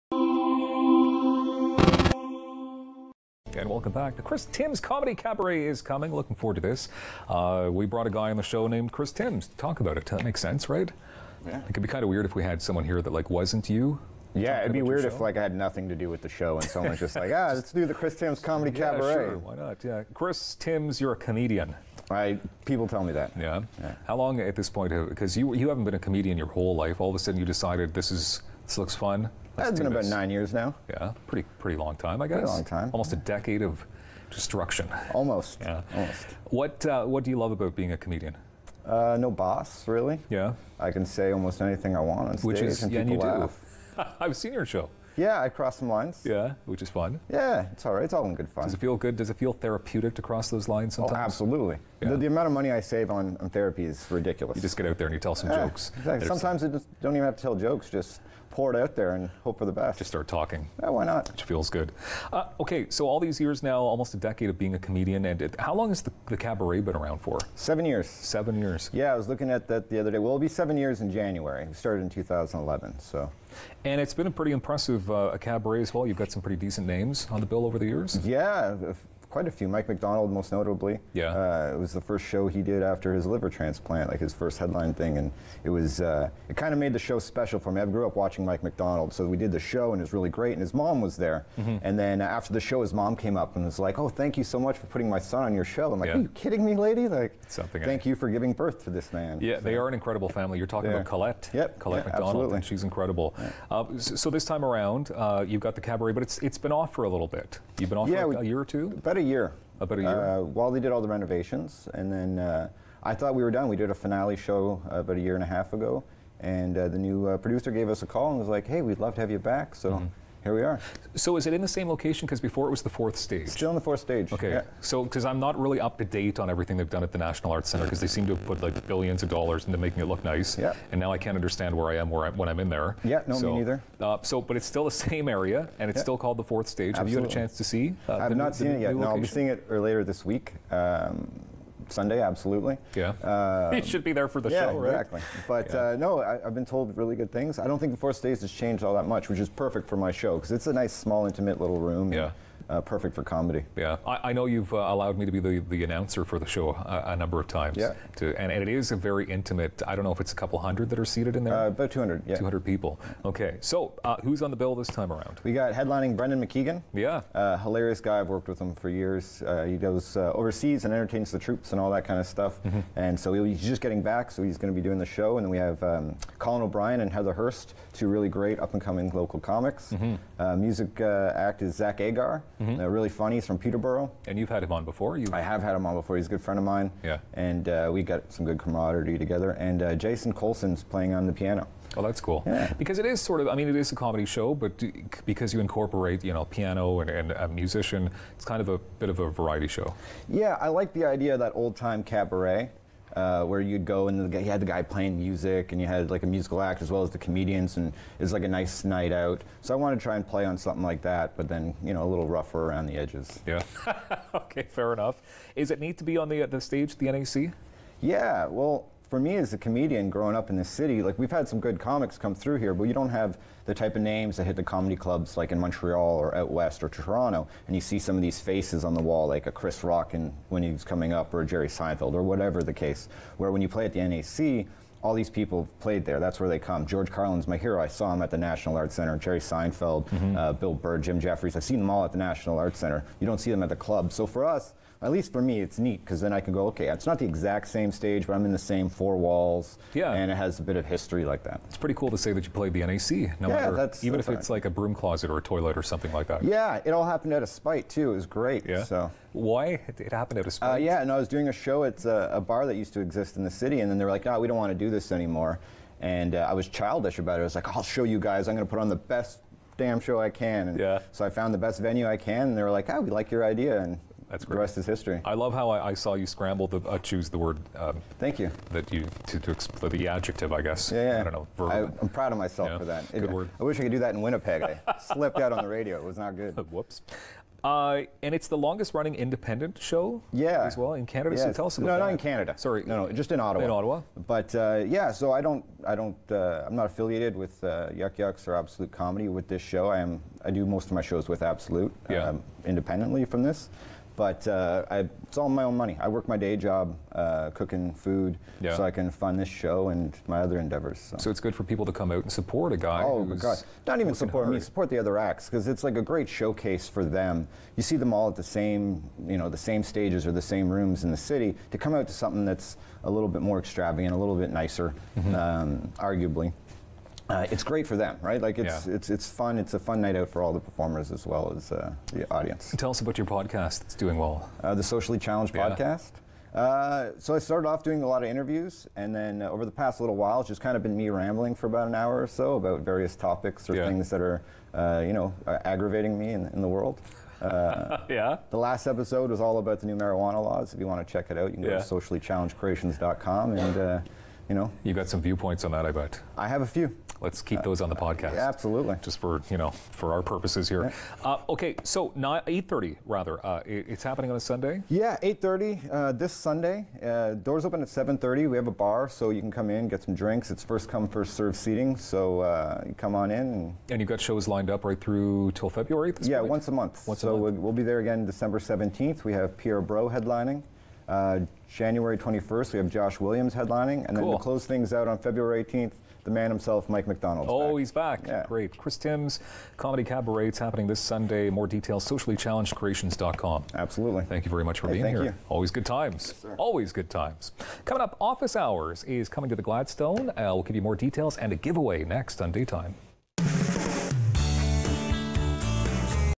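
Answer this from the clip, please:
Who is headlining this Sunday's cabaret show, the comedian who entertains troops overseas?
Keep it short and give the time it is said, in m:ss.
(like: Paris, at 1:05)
Brendan McKeegan, at 2:46.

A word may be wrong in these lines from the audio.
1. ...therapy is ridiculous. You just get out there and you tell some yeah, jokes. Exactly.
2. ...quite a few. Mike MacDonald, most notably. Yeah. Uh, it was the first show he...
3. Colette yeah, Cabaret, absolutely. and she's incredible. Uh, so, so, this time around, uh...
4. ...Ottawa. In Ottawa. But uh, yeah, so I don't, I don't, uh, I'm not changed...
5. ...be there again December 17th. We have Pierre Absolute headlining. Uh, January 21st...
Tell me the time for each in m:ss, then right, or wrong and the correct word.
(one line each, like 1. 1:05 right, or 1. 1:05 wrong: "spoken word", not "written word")
1. 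0:53 right
2. 1:19 right
3. 1:41 wrong: "MacDonald", not "Cabaret"
4. 4:53 wrong: "affiliated", not "changed"
5. 6:17 wrong: "Brault", not "Absolute".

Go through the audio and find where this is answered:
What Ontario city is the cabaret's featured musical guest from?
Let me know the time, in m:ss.
3:03.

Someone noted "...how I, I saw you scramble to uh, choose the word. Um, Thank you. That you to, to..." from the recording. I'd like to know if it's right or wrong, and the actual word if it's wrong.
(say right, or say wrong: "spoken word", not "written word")
right.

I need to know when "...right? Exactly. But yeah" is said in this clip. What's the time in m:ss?
2:24.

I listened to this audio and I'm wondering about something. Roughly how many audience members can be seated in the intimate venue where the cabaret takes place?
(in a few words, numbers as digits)
200.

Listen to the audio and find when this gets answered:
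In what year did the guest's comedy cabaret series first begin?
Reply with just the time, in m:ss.
1:12.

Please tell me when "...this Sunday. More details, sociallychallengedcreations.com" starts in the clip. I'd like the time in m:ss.
6:30.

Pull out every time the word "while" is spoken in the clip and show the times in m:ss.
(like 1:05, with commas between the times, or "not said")
1:50, 5:40.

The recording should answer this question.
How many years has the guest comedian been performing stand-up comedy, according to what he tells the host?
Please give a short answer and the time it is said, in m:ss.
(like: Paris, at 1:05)
9 years, at 0:30.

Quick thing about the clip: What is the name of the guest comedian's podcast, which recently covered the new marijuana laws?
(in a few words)
Socially Challenged.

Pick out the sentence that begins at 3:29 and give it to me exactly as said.
So I want to try and play on something like that, but then you know a little rougher around the edges.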